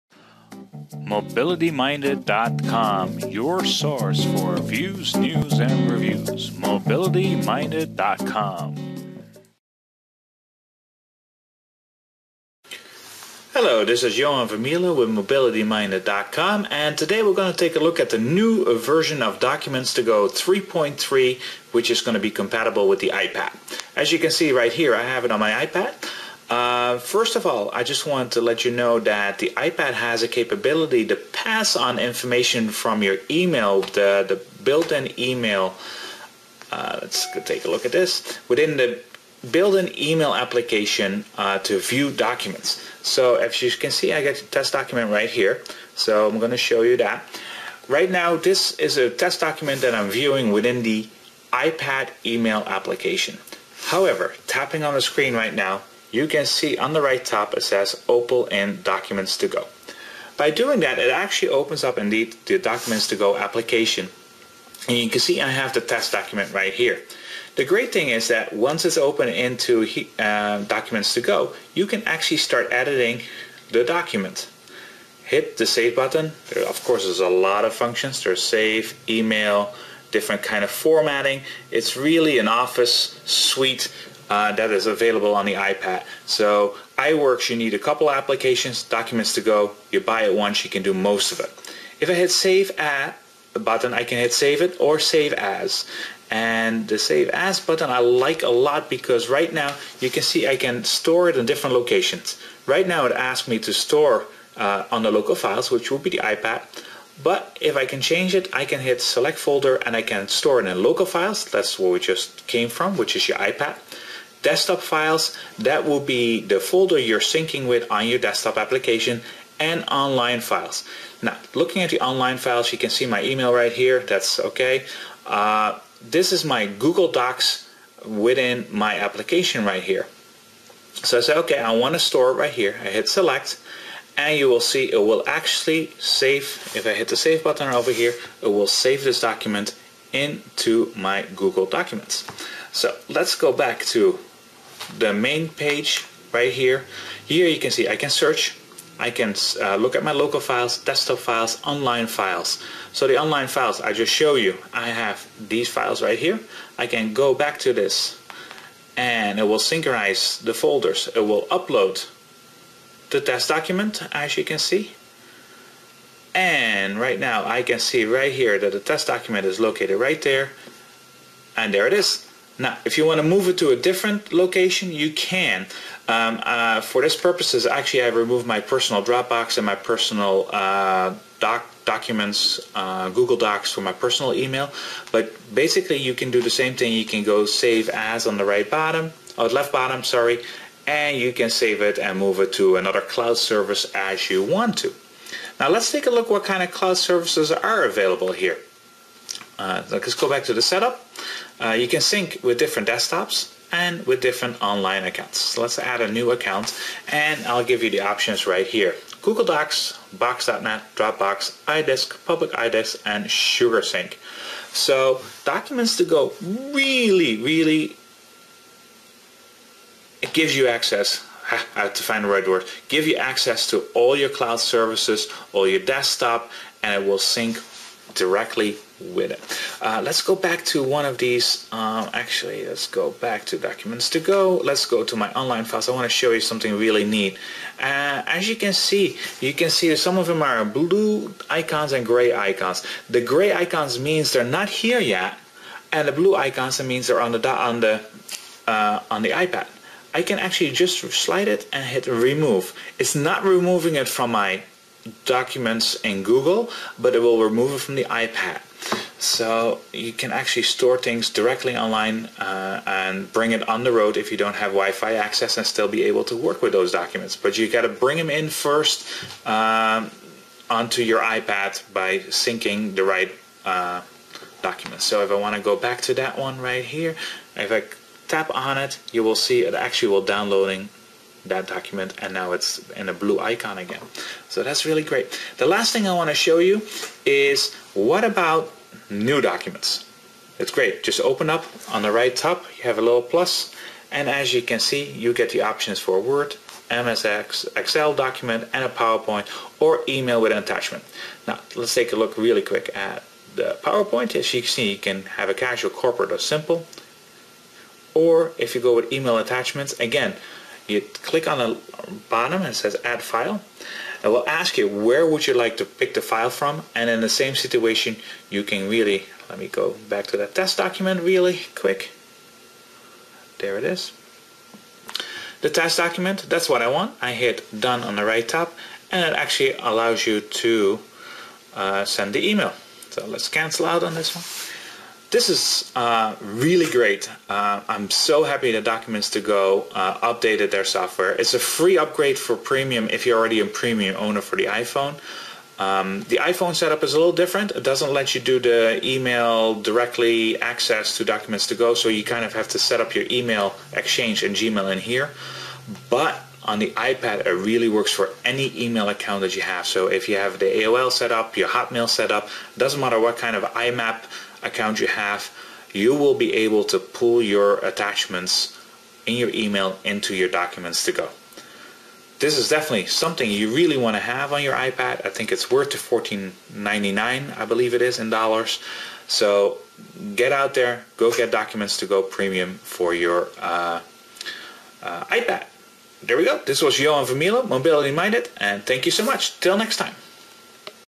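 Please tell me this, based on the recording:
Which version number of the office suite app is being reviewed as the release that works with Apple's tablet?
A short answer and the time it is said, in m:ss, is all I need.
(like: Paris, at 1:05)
3.3, at 0:20.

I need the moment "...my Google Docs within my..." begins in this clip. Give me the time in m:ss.
2:06.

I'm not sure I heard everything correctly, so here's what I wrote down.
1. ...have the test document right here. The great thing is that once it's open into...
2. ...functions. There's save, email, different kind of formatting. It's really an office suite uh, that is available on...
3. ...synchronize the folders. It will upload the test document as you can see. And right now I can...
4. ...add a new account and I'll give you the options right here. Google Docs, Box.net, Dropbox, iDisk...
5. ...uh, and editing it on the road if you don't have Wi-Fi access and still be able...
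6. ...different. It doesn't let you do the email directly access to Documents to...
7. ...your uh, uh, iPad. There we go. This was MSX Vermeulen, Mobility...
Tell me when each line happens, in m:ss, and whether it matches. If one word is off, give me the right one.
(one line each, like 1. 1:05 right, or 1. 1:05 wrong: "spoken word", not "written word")
1. 1:05 right
2. 1:17 right
3. 2:39 right
4. 3:25 right
5. 4:22 wrong: "bring", not "editing"
6. 5:47 right
7. 6:23 wrong: "Johan", not "MSX".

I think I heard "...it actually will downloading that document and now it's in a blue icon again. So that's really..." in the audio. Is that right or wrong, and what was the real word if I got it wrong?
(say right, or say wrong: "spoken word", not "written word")
right.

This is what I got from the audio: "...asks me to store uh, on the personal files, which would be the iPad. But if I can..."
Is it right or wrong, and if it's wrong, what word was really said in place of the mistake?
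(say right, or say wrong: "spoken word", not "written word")
wrong: "local", not "personal".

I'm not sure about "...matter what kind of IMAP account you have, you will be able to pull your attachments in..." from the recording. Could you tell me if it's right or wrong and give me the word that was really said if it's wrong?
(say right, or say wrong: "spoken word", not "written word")
right.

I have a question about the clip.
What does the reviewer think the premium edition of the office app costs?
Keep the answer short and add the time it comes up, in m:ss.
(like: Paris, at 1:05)
$14.99, at 6:15.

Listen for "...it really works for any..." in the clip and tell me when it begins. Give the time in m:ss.
5:57.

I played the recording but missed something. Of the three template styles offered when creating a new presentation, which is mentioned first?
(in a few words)
Casual.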